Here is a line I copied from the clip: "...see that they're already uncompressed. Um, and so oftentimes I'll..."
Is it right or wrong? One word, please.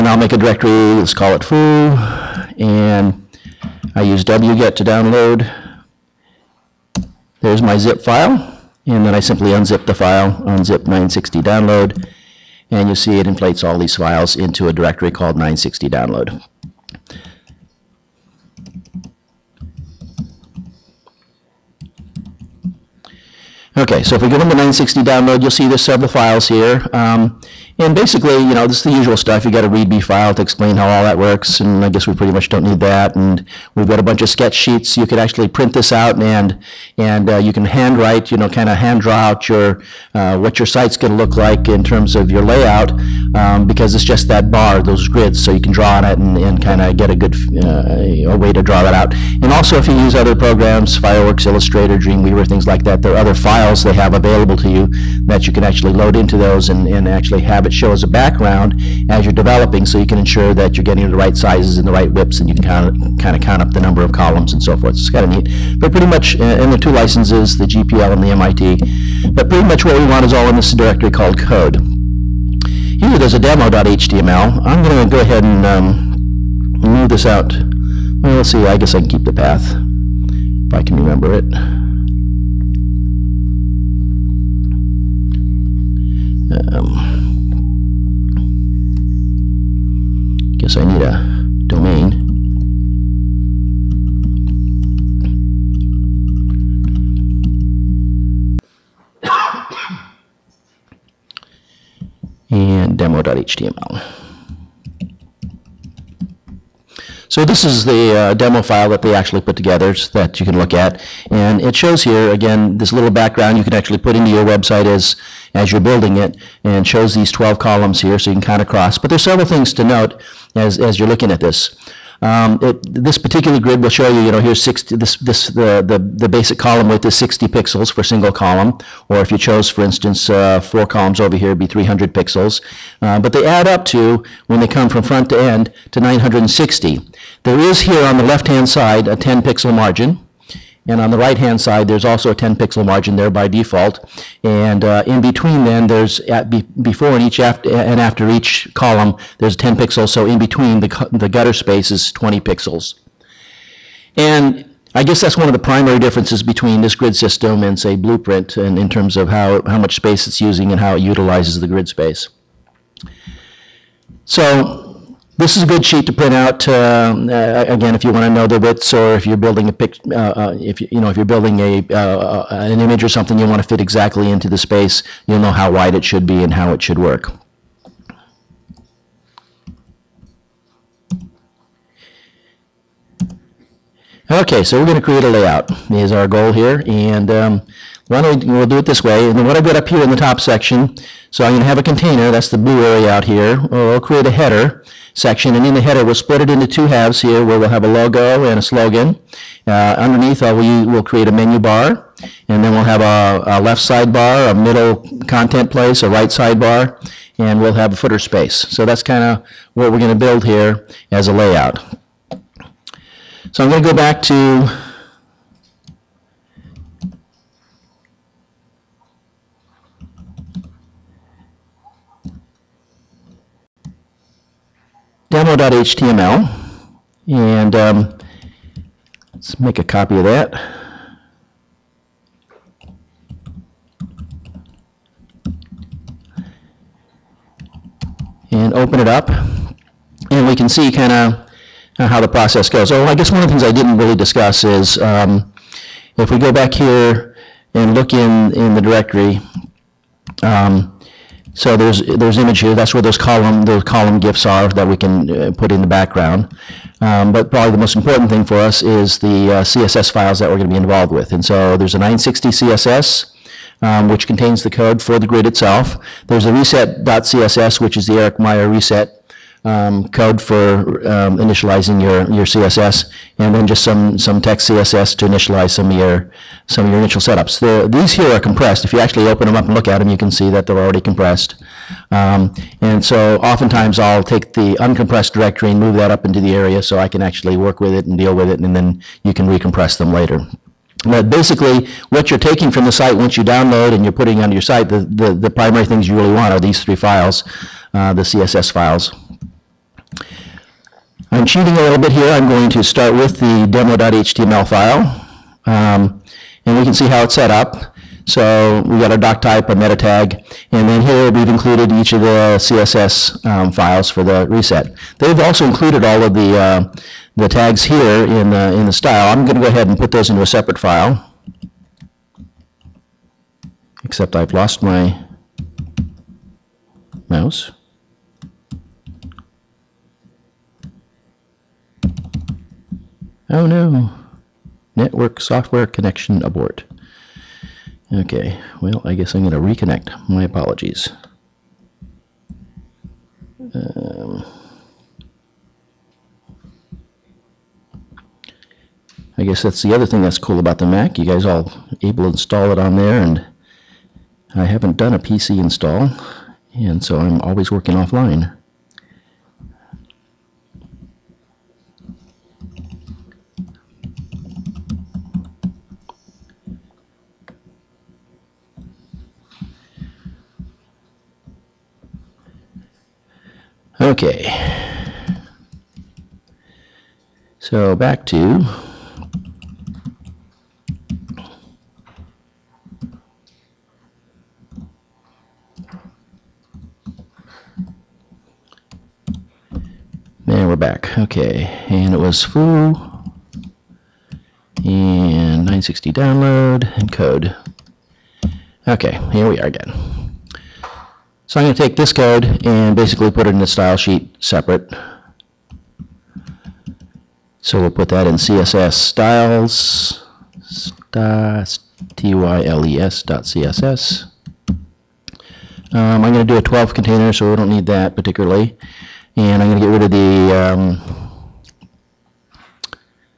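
wrong.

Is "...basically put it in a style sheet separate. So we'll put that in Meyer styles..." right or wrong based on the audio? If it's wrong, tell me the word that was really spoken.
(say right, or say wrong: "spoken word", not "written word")
wrong: "CSS", not "Meyer".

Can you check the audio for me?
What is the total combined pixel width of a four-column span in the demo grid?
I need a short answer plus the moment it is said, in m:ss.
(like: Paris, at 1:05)
300 pixels, at 2:11.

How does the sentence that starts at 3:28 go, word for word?
So that's kind of what we're going to build here as a layout.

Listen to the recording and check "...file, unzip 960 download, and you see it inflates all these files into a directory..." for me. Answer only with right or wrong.
right.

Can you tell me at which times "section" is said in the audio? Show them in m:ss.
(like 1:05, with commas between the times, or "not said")
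3:10, 3:15.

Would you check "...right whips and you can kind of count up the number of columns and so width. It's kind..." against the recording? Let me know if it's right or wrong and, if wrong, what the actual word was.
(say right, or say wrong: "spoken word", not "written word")
wrong: "forth", not "width".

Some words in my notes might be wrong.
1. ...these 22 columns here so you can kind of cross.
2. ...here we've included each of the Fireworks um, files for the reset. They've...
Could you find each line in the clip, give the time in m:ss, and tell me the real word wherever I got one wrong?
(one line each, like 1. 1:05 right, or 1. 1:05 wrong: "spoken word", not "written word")
1. 1:57 wrong: "12", not "22"
2. 5:11 wrong: "CSS", not "Fireworks".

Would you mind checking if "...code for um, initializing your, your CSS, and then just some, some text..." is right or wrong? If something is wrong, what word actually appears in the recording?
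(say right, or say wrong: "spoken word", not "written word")
right.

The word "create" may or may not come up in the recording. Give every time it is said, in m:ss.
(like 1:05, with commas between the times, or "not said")
3:05, 3:14, 3:21.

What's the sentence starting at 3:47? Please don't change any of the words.
And um, let's make a copy of that.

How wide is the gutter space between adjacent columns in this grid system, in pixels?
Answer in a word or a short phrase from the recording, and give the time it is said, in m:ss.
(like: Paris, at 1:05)
20 pixels, at 2:32.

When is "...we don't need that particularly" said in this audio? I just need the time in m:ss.
6:57.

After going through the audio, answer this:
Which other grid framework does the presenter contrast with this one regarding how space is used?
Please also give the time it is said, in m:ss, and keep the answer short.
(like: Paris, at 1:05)
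Blueprint, at 2:37.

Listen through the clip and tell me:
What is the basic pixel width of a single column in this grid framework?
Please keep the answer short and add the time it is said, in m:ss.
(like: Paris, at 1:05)
60 pixels, at 2:07.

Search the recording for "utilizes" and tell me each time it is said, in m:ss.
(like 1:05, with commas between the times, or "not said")
2:41.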